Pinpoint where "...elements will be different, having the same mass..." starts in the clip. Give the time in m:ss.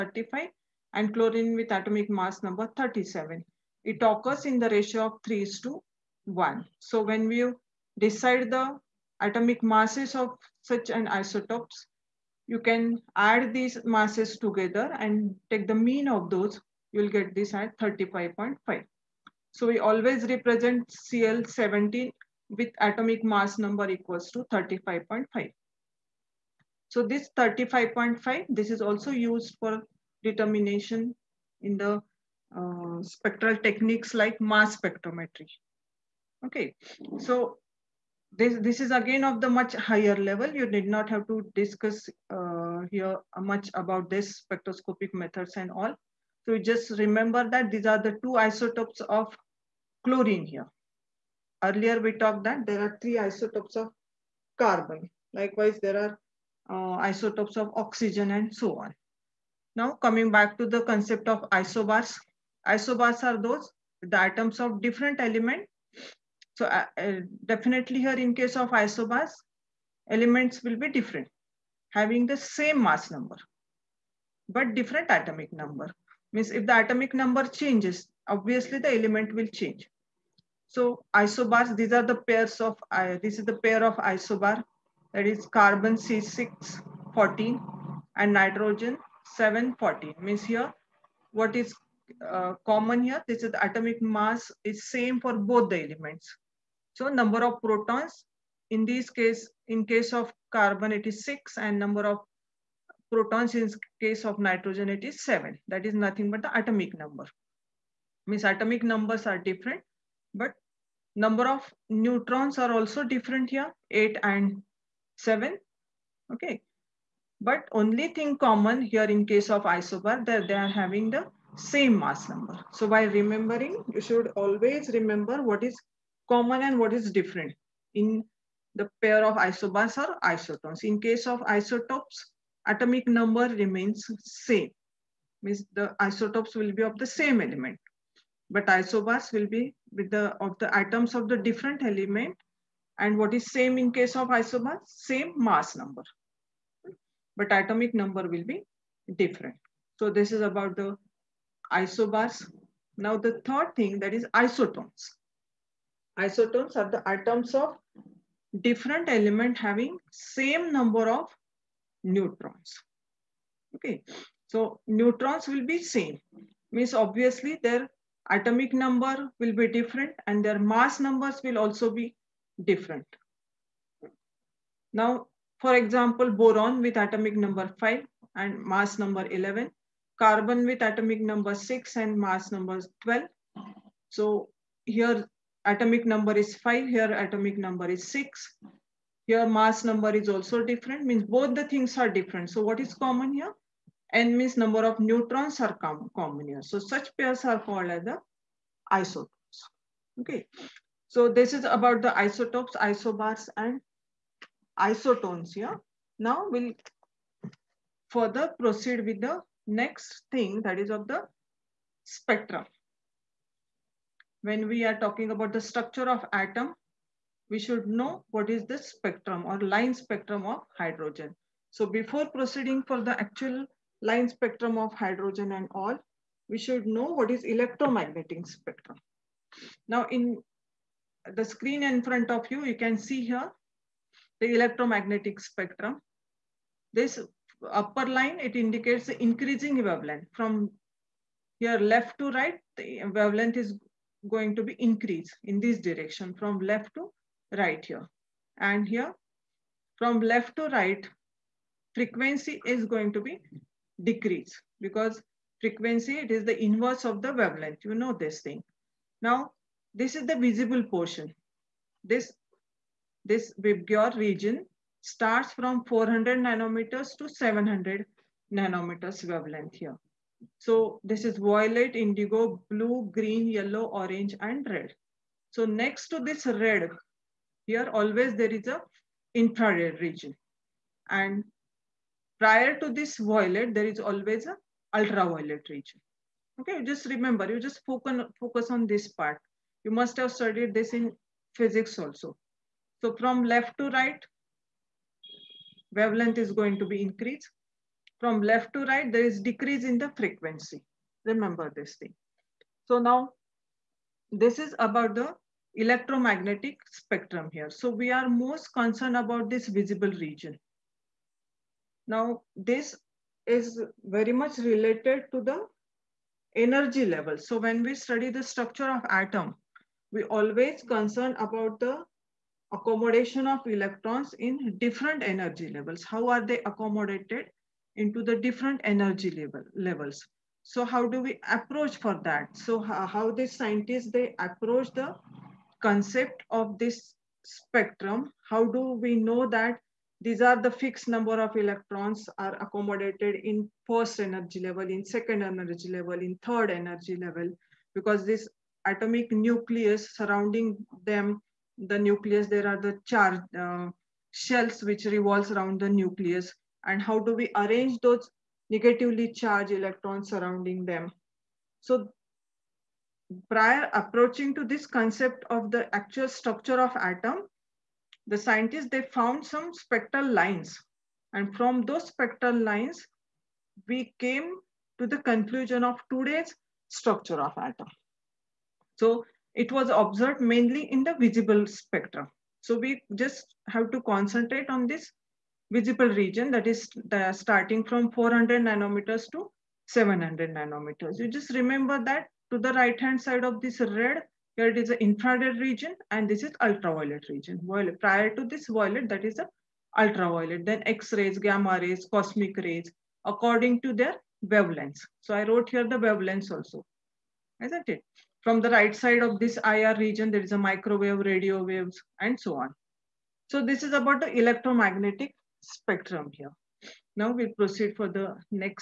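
1:10.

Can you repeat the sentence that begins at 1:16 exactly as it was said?
Means if the atomic number changes, obviously the element will change.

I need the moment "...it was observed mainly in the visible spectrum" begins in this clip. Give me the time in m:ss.
6:19.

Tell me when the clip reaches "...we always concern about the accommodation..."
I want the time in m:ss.
5:20.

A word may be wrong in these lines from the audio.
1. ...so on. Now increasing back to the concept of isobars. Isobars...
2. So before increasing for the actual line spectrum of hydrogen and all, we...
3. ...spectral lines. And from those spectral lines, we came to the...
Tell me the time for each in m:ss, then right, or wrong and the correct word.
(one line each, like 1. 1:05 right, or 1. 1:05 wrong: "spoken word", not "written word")
1. 0:58 wrong: "coming", not "increasing"
2. 3:41 wrong: "proceeding", not "increasing"
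3. 6:09 right.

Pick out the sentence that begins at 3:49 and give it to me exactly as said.
Now in the screen in front of you, you can see here the electromagnetic spectrum.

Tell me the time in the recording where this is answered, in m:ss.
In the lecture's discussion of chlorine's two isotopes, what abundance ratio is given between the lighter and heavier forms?
0:05.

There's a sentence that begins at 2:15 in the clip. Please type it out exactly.
Means the isotopes will be of the same element, but isobars will be with the of the atoms of the different element.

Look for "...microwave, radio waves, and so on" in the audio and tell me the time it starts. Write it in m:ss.
6:50.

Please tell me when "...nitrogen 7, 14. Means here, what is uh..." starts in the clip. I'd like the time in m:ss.
1:28.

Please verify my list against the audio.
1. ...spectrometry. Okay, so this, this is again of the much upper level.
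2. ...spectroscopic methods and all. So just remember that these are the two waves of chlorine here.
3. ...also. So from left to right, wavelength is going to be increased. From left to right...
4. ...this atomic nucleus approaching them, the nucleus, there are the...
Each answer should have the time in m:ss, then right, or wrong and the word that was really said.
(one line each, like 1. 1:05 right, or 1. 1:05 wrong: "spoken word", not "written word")
1. 0:34 wrong: "higher", not "upper"
2. 0:44 wrong: "isotopes", not "waves"
3. 4:51 right
4. 5:48 wrong: "surrounding", not "approaching".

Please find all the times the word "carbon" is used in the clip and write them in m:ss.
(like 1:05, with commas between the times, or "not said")
0:54, 1:25, 1:40, 3:00.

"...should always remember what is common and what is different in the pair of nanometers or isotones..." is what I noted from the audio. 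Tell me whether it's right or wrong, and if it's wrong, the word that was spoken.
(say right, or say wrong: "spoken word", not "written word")
wrong: "isobars", not "nanometers".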